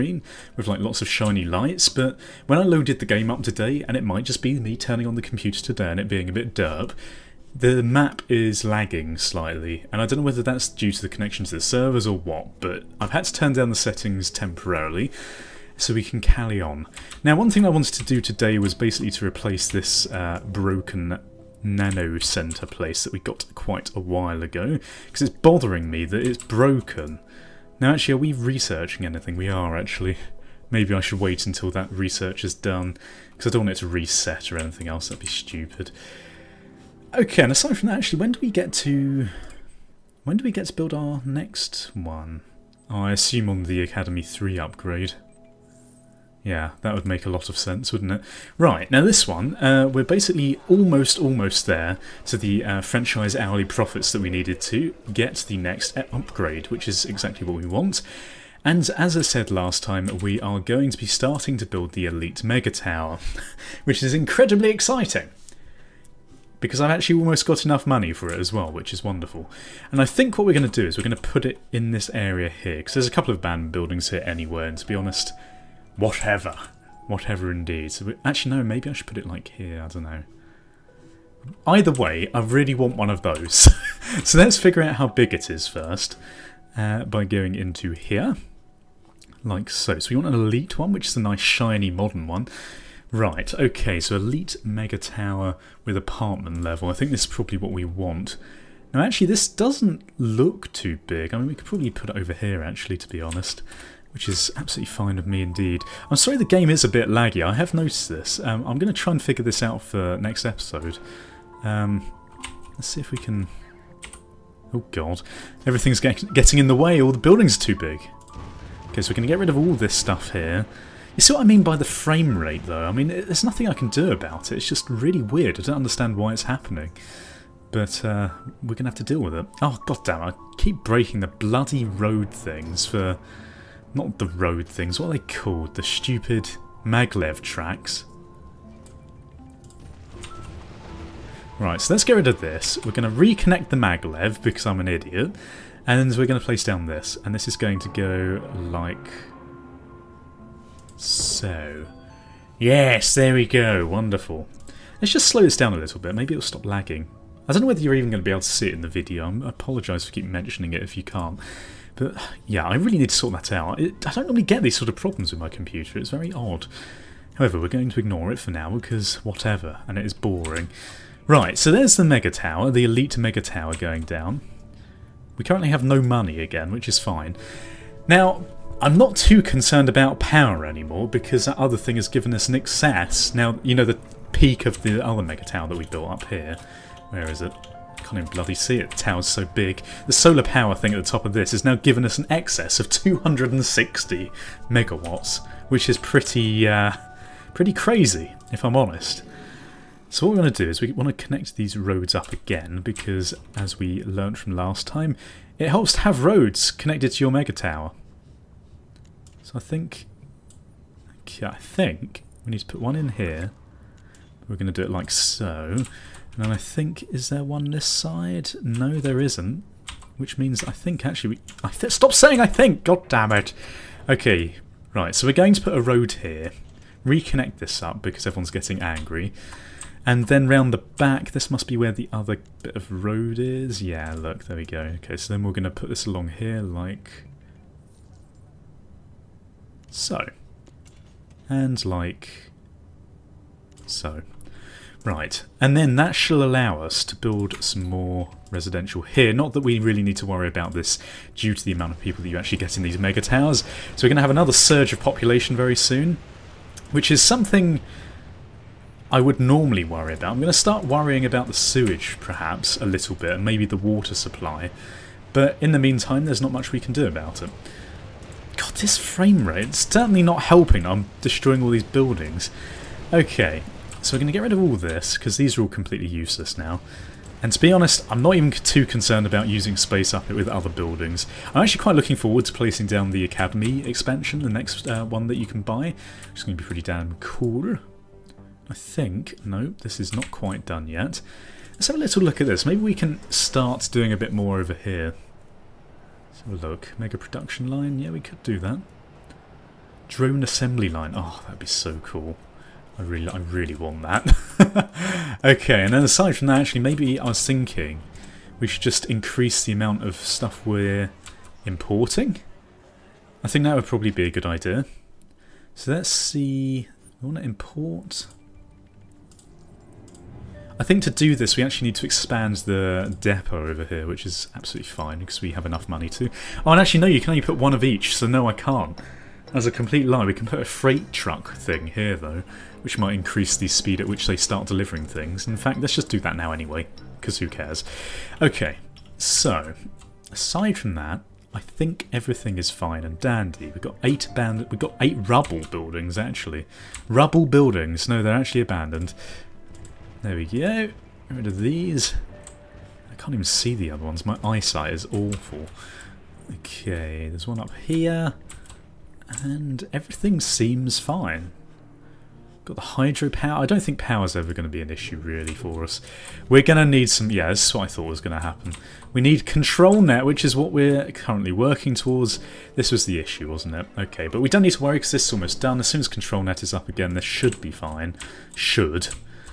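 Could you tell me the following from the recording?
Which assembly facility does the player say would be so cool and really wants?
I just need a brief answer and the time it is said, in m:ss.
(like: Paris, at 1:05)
Drone assembly line, at 5:00.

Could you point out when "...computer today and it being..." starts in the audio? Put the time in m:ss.
0:05.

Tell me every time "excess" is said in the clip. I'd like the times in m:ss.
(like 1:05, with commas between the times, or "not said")
3:02, 3:12.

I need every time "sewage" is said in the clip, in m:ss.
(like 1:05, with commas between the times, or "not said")
4:21.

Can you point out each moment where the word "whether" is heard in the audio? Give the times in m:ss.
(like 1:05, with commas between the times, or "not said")
0:10, 2:37.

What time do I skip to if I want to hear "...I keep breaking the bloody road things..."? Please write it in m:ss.
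2:10.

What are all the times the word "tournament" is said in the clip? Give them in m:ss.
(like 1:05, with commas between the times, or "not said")
not said.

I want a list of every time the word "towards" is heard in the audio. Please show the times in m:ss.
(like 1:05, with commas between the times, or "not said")
6:11.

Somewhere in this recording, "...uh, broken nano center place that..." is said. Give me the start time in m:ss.
0:20.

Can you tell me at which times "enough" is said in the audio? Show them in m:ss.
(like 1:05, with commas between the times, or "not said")
1:07, 5:25.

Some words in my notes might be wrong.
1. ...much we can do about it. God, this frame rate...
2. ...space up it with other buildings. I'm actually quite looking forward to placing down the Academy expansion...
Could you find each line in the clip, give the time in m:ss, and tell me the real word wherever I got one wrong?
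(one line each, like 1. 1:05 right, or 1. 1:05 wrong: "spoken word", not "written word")
1. 4:26 right
2. 4:39 right.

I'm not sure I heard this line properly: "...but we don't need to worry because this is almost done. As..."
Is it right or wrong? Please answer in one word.
right.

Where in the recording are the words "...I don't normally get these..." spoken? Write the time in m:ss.
2:44.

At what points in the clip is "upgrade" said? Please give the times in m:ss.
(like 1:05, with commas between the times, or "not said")
0:44, 0:55.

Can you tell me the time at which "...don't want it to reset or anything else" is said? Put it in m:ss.
0:33.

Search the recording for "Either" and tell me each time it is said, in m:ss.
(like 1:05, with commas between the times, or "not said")
1:21.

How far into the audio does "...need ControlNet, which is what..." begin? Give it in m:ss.
6:09.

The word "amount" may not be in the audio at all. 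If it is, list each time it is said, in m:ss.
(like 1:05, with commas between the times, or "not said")
4:11, 5:09.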